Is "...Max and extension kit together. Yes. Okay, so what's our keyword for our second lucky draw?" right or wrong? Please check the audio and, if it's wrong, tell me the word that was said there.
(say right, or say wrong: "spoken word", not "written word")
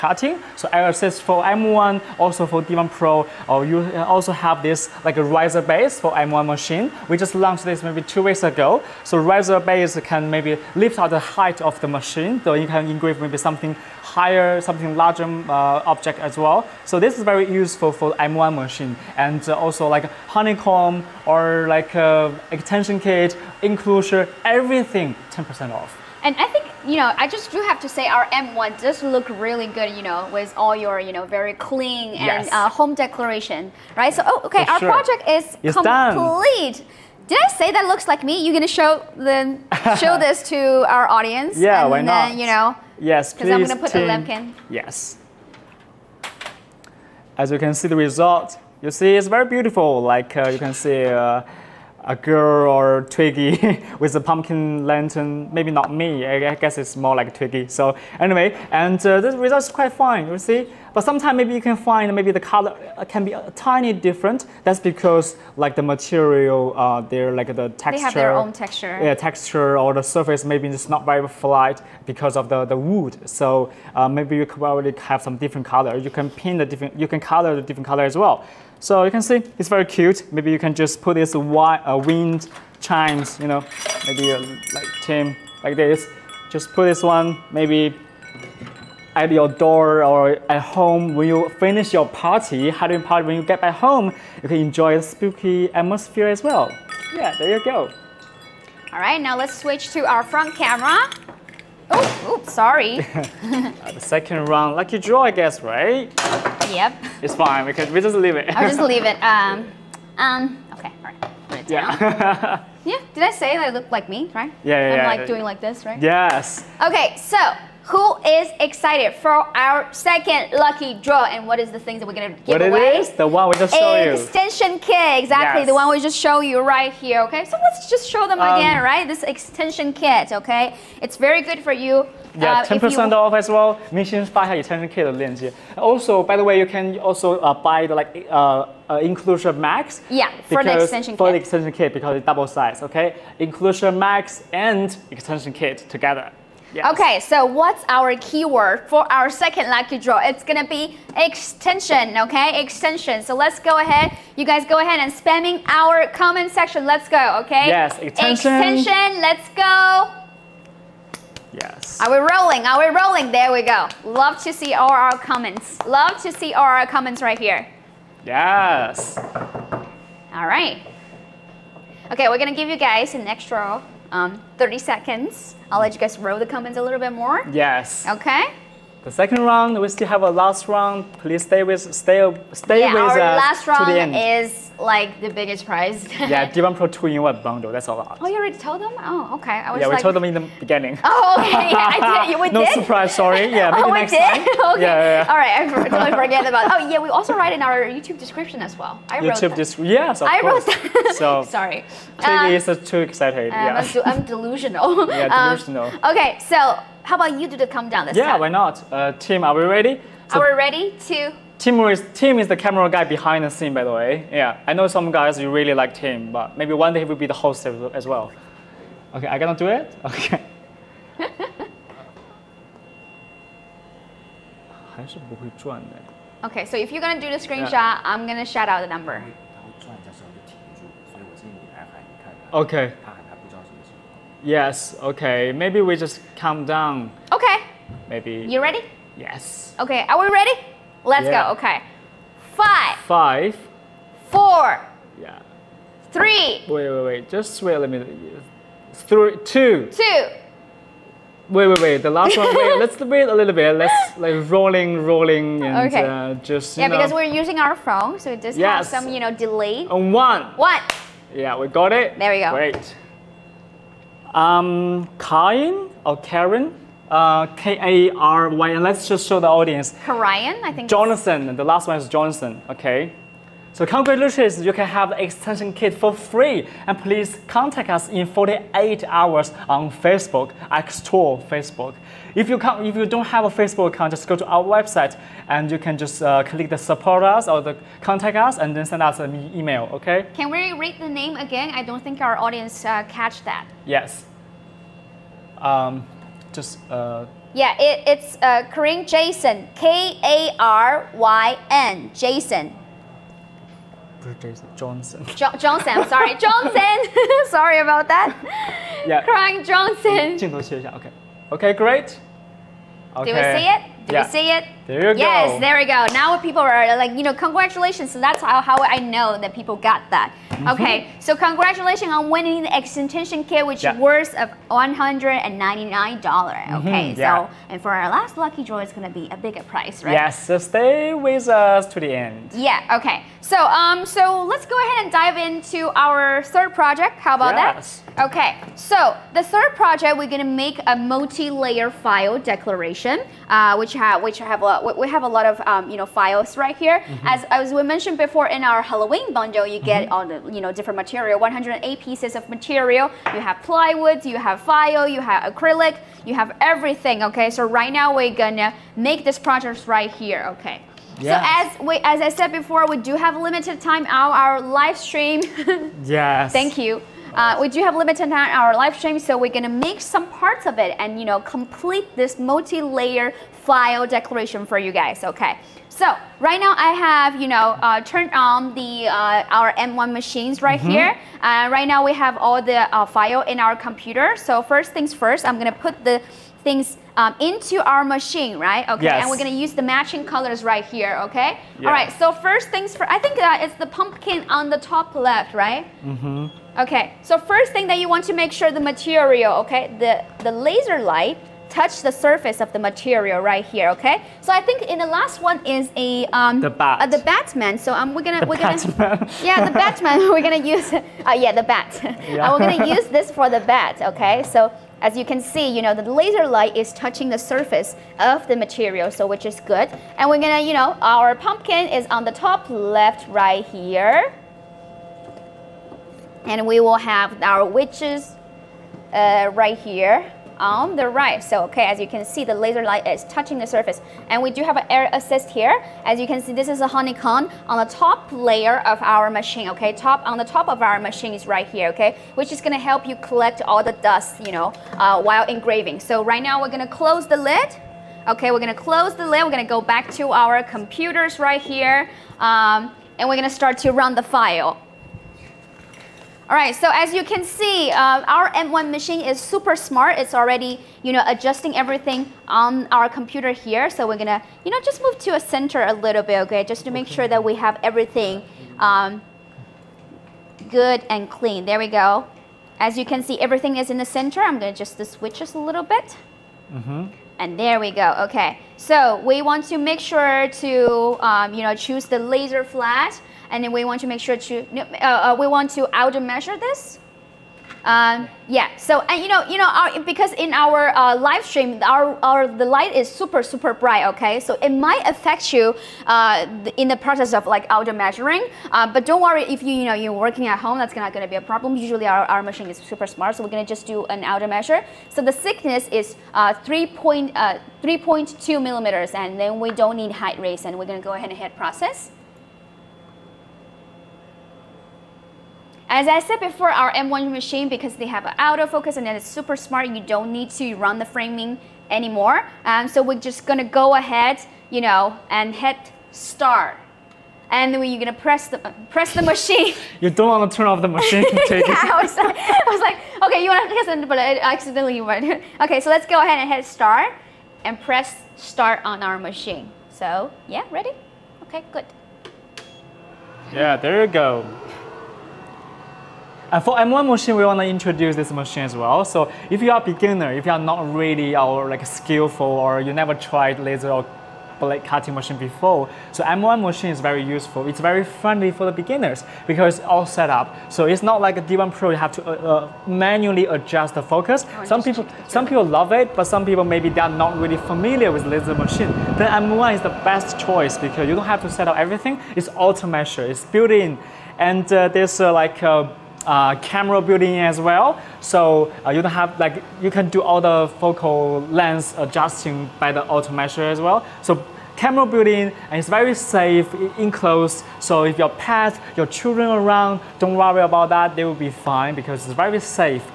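right.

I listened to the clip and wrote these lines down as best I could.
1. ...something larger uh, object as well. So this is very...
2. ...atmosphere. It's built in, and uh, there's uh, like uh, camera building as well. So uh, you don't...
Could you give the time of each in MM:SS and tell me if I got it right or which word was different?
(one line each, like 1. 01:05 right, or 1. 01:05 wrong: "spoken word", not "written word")
1. 00:14 right
2. 09:32 wrong: "measure", not "atmosphere".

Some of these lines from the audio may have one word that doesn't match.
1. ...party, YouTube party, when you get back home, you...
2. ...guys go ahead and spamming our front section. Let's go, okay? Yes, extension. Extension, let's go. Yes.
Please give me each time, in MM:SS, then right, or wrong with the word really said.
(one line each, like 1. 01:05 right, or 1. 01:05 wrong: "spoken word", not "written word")
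1. 01:32 wrong: "Halloween", not "YouTube"
2. 02:34 wrong: "comment", not "front".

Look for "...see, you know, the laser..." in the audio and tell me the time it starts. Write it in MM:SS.
06:55.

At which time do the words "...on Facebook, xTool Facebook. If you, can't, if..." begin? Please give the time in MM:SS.
04:39.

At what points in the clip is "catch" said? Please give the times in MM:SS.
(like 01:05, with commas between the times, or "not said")
04:53.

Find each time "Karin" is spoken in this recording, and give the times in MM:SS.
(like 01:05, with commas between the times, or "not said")
04:58, 05:09.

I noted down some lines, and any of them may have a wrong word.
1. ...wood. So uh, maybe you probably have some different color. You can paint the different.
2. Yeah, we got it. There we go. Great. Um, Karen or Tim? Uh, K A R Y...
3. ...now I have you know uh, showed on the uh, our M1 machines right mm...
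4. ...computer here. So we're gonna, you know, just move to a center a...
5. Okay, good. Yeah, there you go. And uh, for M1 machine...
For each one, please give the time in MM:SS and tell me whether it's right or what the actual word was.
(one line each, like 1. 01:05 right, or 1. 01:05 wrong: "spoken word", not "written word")
1. 01:12 right
2. 04:21 wrong: "Karen", not "Tim"
3. 06:16 wrong: "turned", not "showed"
4. 07:43 right
5. 09:01 right.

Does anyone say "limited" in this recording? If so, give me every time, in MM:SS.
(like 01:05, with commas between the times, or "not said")
06:03, 06:07.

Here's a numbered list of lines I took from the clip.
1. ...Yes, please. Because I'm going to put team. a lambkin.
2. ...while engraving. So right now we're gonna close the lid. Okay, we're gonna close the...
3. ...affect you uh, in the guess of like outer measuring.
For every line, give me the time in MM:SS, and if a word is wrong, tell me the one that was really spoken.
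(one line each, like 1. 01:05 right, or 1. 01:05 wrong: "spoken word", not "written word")
1. 00:42 right
2. 07:25 right
3. 08:15 wrong: "process", not "guess".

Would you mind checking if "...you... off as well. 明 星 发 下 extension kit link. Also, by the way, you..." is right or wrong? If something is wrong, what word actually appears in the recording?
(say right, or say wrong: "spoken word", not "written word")
right.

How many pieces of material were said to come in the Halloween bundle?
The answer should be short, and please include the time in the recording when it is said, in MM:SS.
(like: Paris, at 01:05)
108, at 05:51.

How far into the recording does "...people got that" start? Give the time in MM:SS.
05:19.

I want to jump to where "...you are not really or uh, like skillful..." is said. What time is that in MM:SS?
09:10.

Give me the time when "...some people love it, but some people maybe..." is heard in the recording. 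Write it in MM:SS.
09:25.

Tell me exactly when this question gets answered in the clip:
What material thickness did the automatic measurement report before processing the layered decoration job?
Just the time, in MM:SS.
08:26.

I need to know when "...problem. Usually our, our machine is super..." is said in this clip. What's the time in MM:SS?
08:21.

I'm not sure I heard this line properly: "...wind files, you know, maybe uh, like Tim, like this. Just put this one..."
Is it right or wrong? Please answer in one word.
wrong.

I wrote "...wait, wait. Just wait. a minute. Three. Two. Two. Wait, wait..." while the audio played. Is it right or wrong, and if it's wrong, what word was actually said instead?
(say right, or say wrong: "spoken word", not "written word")
right.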